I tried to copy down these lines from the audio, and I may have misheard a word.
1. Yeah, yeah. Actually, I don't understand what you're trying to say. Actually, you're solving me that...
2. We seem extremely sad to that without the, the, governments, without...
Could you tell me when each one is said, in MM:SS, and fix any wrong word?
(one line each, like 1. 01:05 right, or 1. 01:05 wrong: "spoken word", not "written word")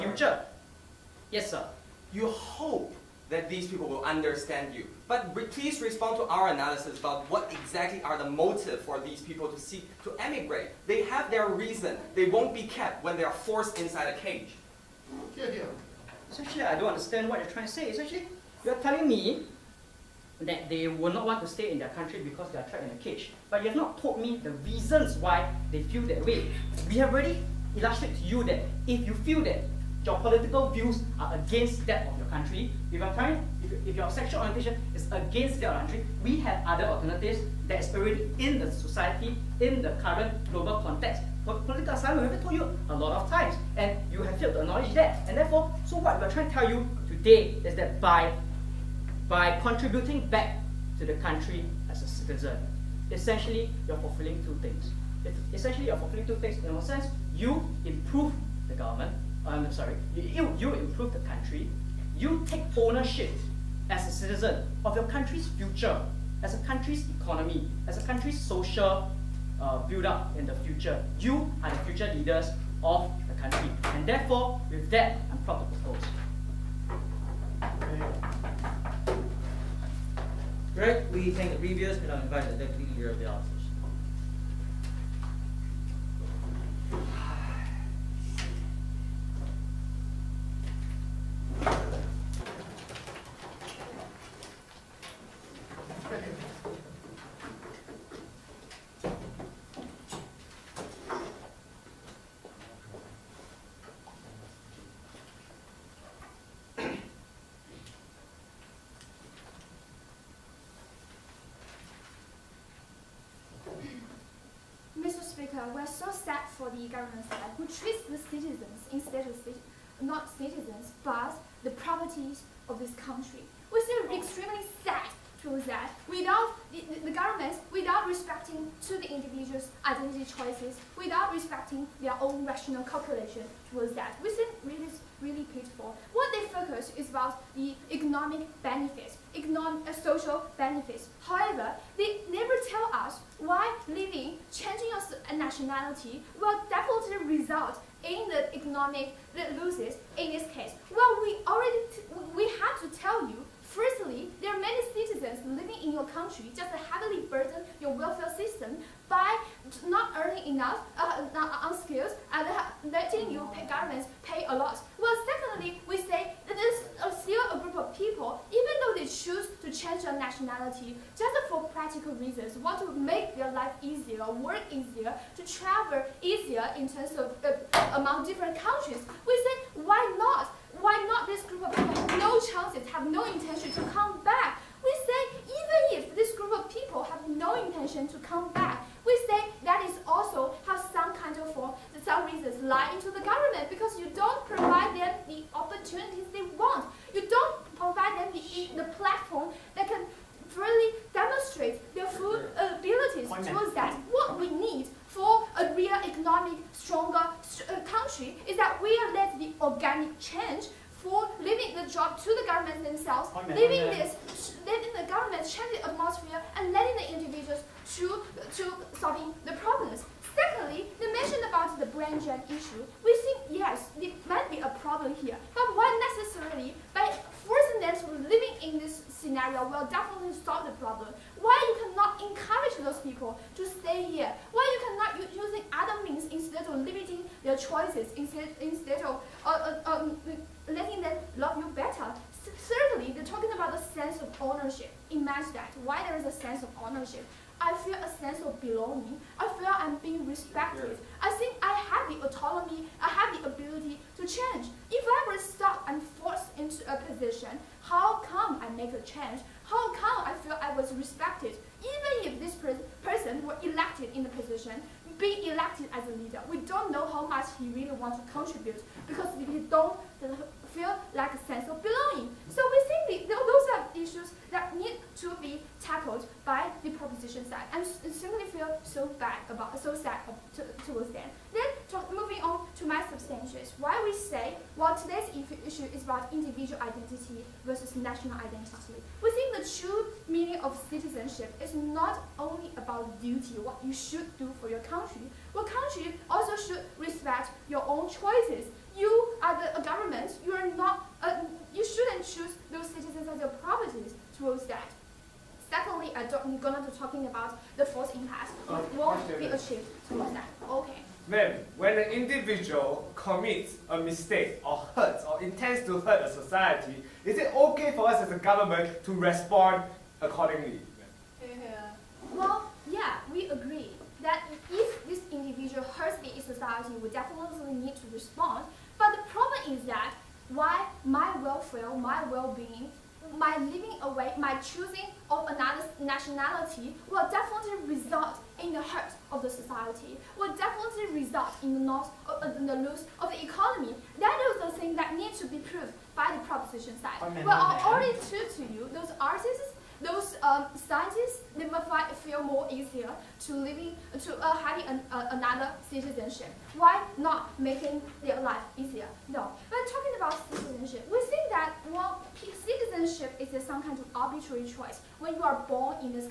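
1. 00:15 wrong: "telling", not "solving"
2. 02:03 right.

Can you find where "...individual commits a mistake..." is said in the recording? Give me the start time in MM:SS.
05:12.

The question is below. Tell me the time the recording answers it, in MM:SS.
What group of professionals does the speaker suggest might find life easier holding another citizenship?
05:50.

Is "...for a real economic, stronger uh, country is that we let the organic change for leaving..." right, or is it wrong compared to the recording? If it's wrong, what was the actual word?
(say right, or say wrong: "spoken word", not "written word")
right.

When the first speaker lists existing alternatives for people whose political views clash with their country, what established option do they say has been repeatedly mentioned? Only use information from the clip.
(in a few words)
Political asylum.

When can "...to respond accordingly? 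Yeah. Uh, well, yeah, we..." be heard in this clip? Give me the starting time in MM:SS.
05:19.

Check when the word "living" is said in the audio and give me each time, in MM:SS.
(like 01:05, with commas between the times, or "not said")
02:23, 02:35, 03:48, 05:33, 05:53.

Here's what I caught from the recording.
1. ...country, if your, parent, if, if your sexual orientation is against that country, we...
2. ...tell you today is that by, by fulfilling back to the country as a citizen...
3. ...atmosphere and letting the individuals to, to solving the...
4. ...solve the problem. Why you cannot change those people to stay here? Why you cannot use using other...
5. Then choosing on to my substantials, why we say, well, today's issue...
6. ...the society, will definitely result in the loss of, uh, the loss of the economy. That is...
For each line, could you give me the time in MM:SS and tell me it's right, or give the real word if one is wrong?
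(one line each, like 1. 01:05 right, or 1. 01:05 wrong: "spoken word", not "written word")
1. 00:32 right
2. 00:46 wrong: "contributing", not "fulfilling"
3. 03:35 right
4. 03:50 wrong: "encourage", not "change"
5. 04:41 wrong: "moving", not "choosing"
6. 05:39 right.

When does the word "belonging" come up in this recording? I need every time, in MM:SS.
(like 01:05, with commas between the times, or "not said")
04:08, 04:31.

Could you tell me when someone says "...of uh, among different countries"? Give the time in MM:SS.
02:57.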